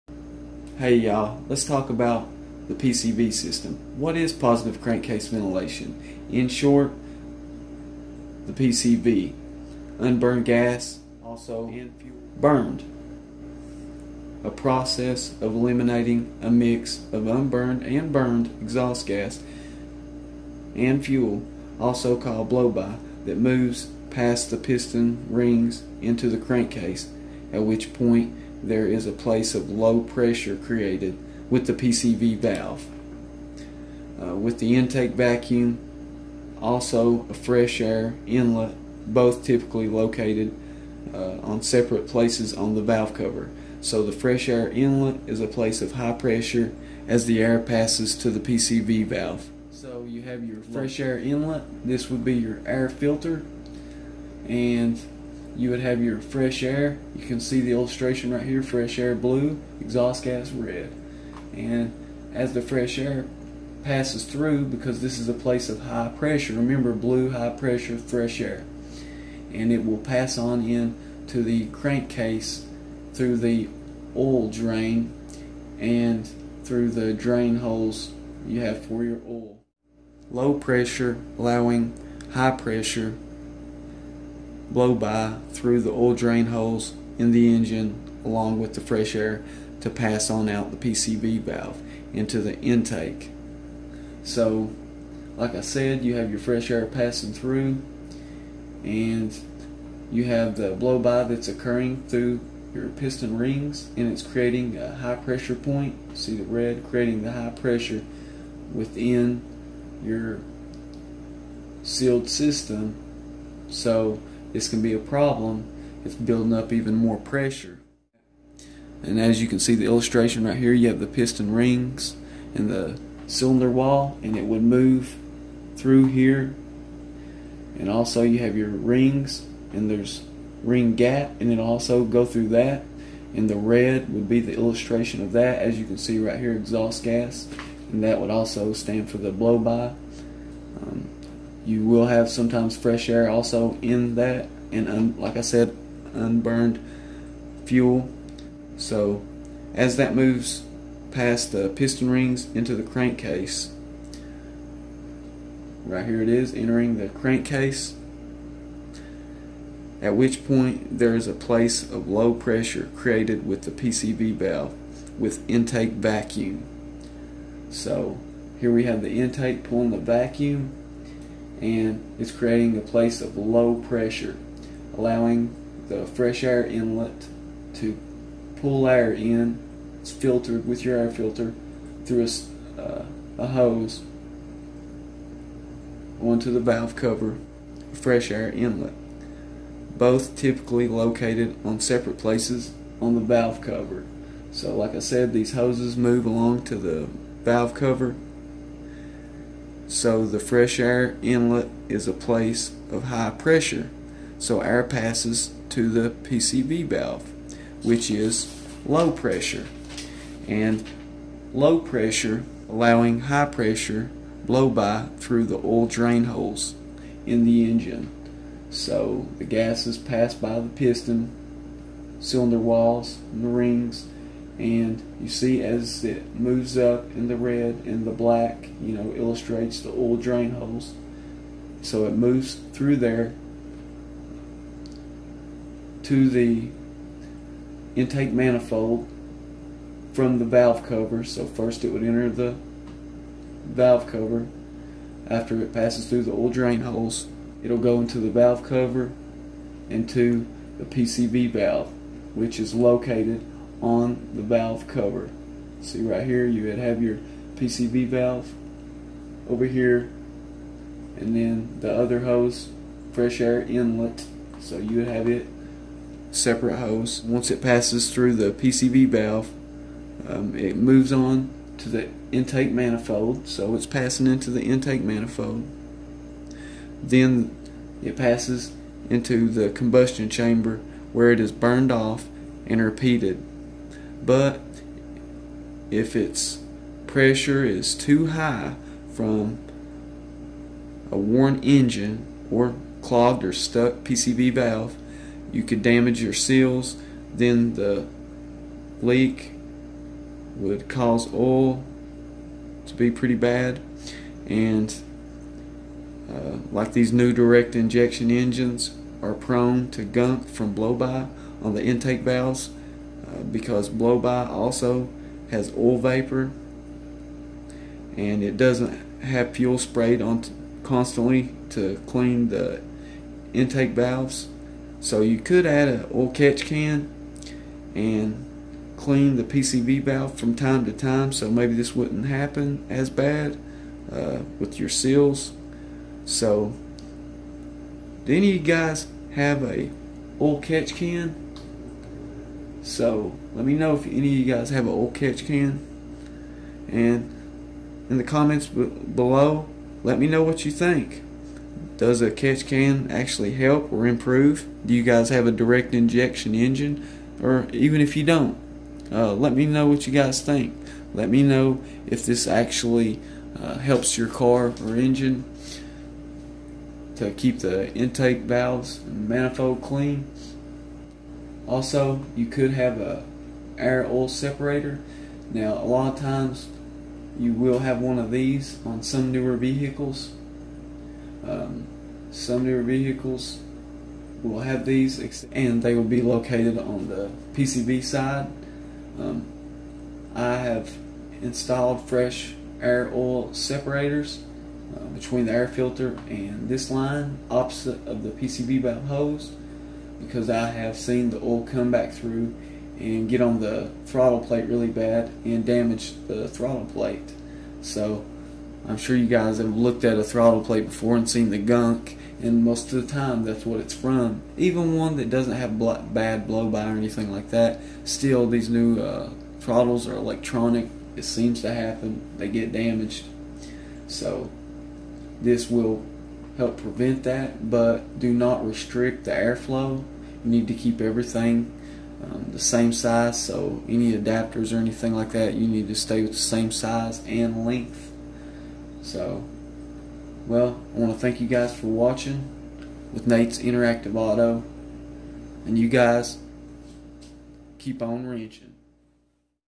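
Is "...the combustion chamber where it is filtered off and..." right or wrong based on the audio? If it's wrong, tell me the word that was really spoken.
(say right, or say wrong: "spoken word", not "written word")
wrong: "burned", not "filtered".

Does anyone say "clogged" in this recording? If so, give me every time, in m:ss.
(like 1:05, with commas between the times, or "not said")
4:53.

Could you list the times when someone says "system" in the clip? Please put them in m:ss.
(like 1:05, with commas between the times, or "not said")
0:03, 1:52.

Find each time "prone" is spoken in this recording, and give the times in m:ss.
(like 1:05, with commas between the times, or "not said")
5:09.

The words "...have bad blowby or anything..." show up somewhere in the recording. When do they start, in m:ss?
6:55.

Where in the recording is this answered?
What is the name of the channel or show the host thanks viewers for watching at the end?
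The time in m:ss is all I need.
7:23.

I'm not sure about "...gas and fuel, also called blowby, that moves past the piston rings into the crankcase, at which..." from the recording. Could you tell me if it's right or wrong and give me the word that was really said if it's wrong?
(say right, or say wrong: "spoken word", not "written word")
right.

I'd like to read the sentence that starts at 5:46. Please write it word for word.
And in the comments below, let me know what you think.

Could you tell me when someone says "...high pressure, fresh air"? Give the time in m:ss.
1:07.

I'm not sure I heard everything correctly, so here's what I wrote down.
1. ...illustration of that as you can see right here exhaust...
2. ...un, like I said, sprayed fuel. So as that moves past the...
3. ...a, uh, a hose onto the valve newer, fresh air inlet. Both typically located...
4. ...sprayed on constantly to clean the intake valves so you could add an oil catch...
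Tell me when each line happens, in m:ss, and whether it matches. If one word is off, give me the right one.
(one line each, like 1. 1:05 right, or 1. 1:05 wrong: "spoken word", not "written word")
1. 2:14 right
2. 2:24 wrong: "unburned", not "sprayed"
3. 3:02 wrong: "cover", not "newer"
4. 5:19 right.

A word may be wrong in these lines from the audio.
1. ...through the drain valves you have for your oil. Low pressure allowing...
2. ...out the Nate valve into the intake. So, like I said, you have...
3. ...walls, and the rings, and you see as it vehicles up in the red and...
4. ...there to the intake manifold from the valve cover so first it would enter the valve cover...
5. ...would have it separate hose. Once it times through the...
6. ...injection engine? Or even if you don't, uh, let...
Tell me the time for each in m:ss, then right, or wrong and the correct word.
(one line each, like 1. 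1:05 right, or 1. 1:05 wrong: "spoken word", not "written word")
1. 1:16 wrong: "holes", not "valves"
2. 1:30 wrong: "PCV", not "Nate"
3. 3:42 wrong: "moves", not "vehicles"
4. 3:52 right
5. 4:24 wrong: "passes", not "times"
6. 5:55 right.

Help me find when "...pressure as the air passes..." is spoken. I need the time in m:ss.
0:46.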